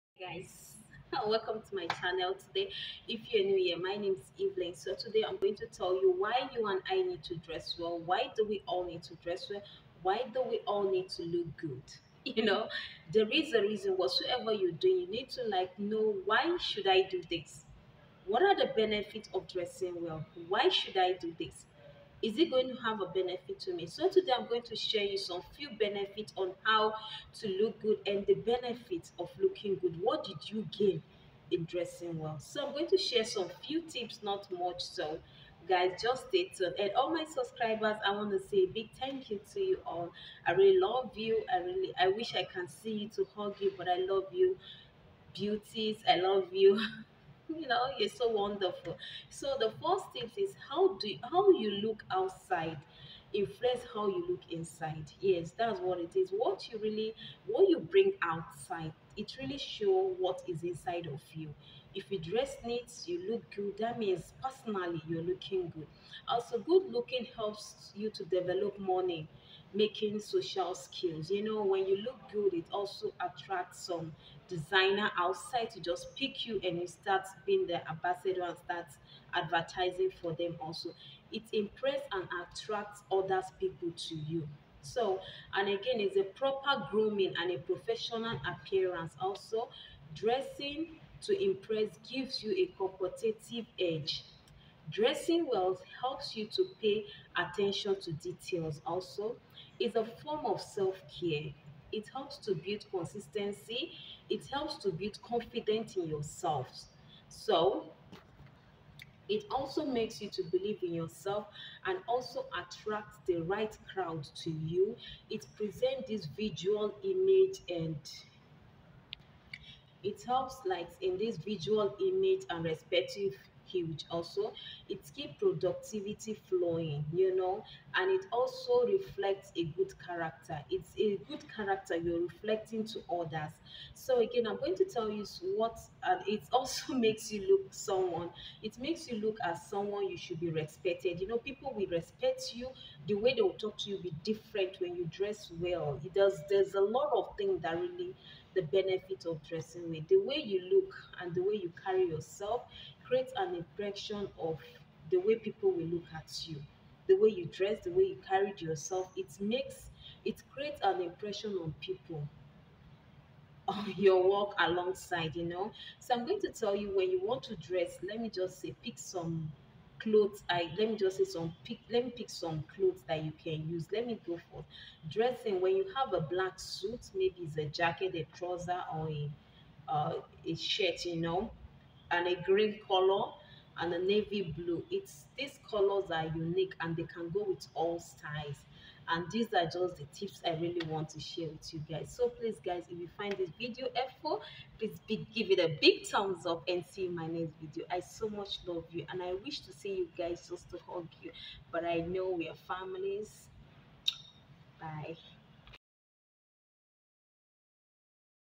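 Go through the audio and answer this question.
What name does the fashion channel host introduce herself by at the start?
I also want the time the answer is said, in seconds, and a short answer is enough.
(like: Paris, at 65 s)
Evelyn, at 4 s.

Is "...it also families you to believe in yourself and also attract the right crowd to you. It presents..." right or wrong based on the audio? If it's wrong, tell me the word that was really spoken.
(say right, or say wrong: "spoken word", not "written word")
wrong: "makes", not "families".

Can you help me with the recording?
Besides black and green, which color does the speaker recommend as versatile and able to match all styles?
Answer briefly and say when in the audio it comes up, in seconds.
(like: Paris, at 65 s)
navy blue, at 184 s.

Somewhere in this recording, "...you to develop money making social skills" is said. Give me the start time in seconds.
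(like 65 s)
67 s.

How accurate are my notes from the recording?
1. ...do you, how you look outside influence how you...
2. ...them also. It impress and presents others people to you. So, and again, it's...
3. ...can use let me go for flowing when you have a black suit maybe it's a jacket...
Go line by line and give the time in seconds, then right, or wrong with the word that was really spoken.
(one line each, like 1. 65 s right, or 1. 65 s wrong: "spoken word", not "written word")
1. 50 s right
2. 80 s wrong: "attracts", not "presents"
3. 173 s wrong: "dressing", not "flowing".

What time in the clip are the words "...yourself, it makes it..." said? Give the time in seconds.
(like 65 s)
158 s.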